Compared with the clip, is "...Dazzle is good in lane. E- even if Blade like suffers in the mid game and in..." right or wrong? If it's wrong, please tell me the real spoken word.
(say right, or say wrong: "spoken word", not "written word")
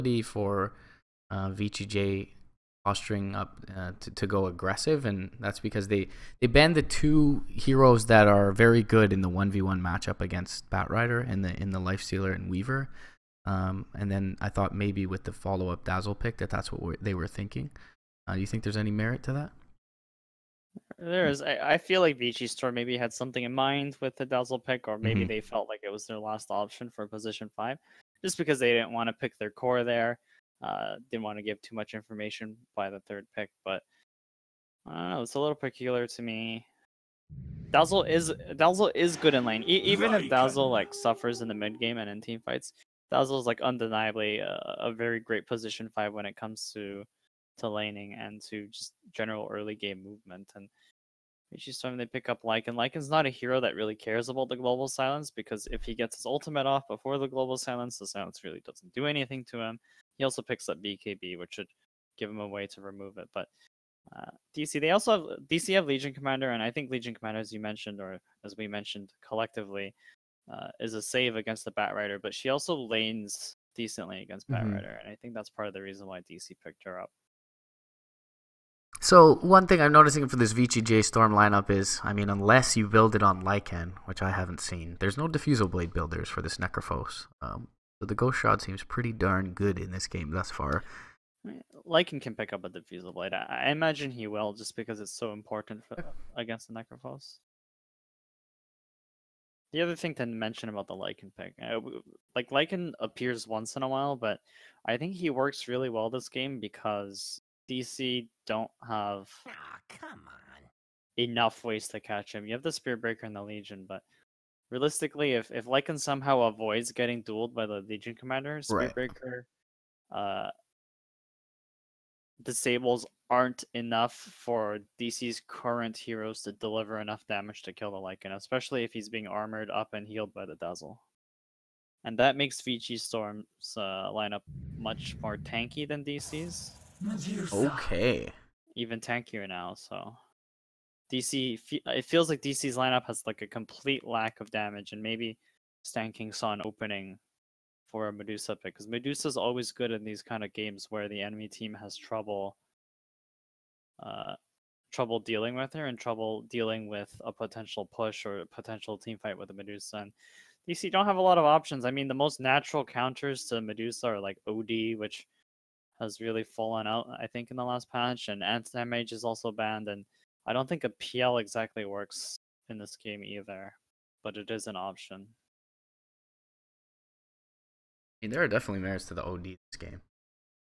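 wrong: "Dazzle", not "Blade".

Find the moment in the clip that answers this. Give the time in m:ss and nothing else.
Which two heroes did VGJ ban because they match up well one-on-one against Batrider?
0:11.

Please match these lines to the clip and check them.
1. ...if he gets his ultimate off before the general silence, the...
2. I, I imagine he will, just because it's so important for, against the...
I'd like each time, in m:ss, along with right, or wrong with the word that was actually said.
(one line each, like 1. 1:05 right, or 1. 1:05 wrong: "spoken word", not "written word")
1. 0:55 wrong: "global", not "general"
2. 1:33 right.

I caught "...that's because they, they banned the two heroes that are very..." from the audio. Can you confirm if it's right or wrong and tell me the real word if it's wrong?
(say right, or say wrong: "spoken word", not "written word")
right.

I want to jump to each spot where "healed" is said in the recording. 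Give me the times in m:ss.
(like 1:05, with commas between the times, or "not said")
2:10.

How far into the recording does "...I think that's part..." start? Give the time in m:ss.
1:15.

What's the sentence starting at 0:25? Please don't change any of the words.
they felt like it was their last option for position five, just because they didn't want to pick their core there.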